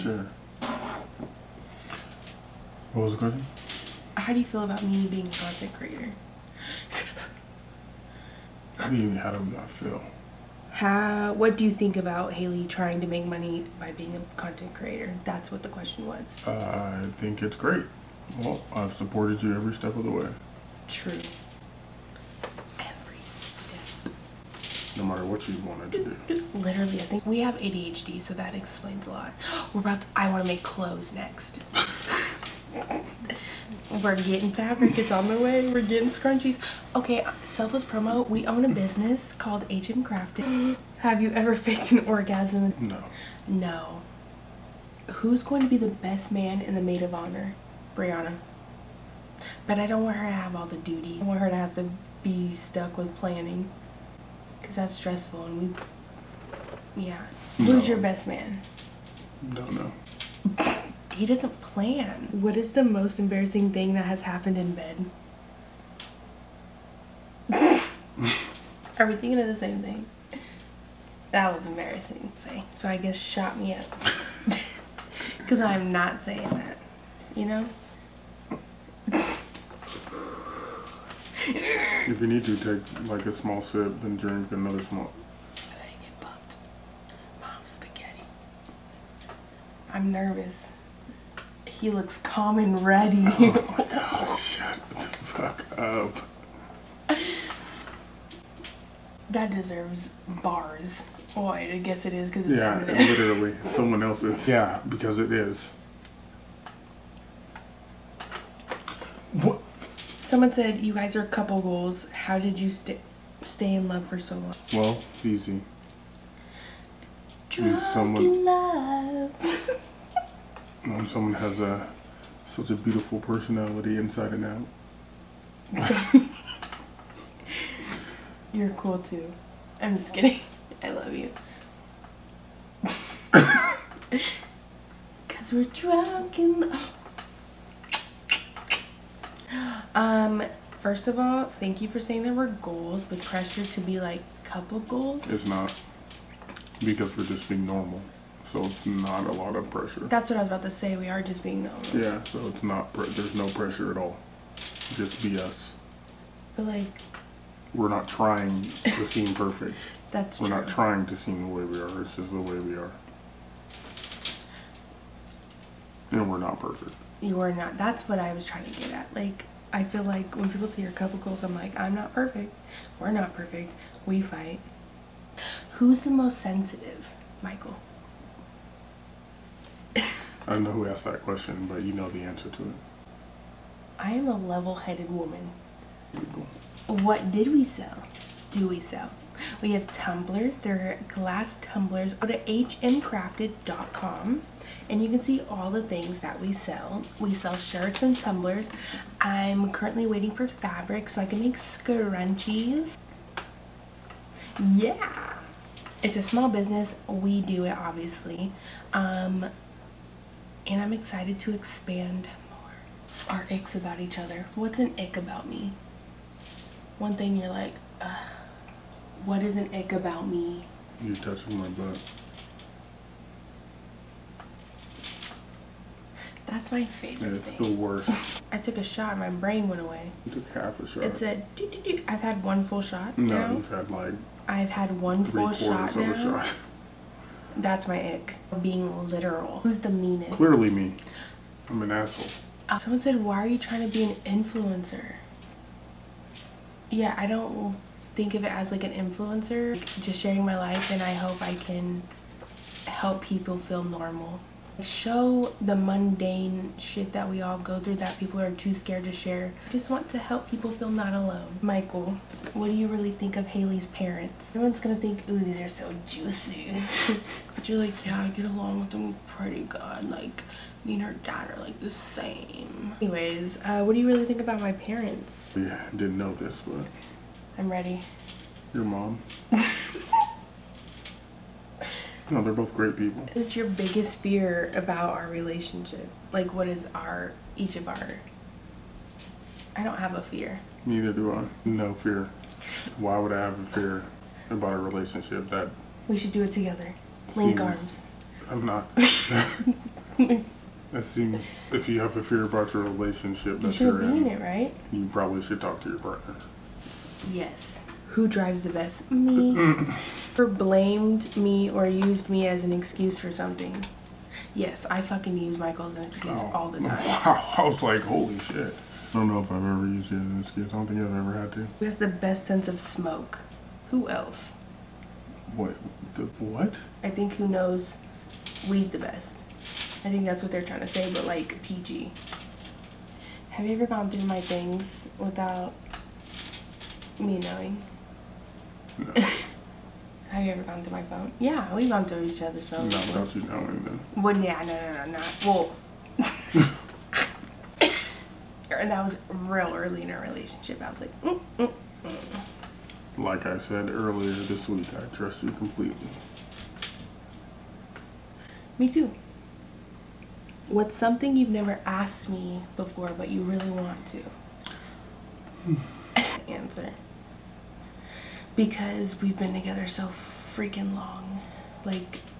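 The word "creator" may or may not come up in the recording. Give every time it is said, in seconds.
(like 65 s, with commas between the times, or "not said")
5 s, 14 s.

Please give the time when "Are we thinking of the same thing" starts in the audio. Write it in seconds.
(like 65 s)
68 s.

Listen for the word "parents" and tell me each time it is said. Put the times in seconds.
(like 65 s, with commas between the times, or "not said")
263 s, 274 s.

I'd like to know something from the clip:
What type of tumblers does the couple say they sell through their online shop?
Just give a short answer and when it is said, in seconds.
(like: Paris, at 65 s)
Glass tumblers, at 191 s.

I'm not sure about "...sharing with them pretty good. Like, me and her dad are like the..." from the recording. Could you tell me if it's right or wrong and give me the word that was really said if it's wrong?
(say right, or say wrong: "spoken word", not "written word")
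wrong: "along", not "sharing".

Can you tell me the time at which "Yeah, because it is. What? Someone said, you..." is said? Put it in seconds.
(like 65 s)
104 s.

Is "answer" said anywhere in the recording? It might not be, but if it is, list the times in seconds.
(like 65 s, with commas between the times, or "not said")
182 s, 366 s.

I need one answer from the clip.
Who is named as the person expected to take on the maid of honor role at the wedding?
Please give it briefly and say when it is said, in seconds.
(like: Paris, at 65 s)
Brianna, at 47 s.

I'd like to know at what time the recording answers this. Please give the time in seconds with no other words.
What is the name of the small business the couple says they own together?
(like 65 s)
39 s.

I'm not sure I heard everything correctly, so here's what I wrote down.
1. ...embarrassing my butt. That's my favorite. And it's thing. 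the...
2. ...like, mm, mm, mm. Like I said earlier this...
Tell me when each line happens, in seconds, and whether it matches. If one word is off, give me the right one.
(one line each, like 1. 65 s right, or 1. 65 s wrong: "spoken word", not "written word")
1. 221 s wrong: "touching", not "embarrassing"
2. 351 s right.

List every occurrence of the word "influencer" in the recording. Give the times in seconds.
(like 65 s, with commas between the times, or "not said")
244 s, 248 s.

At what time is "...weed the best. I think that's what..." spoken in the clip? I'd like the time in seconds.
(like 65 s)
328 s.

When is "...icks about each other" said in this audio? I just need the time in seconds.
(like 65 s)
213 s.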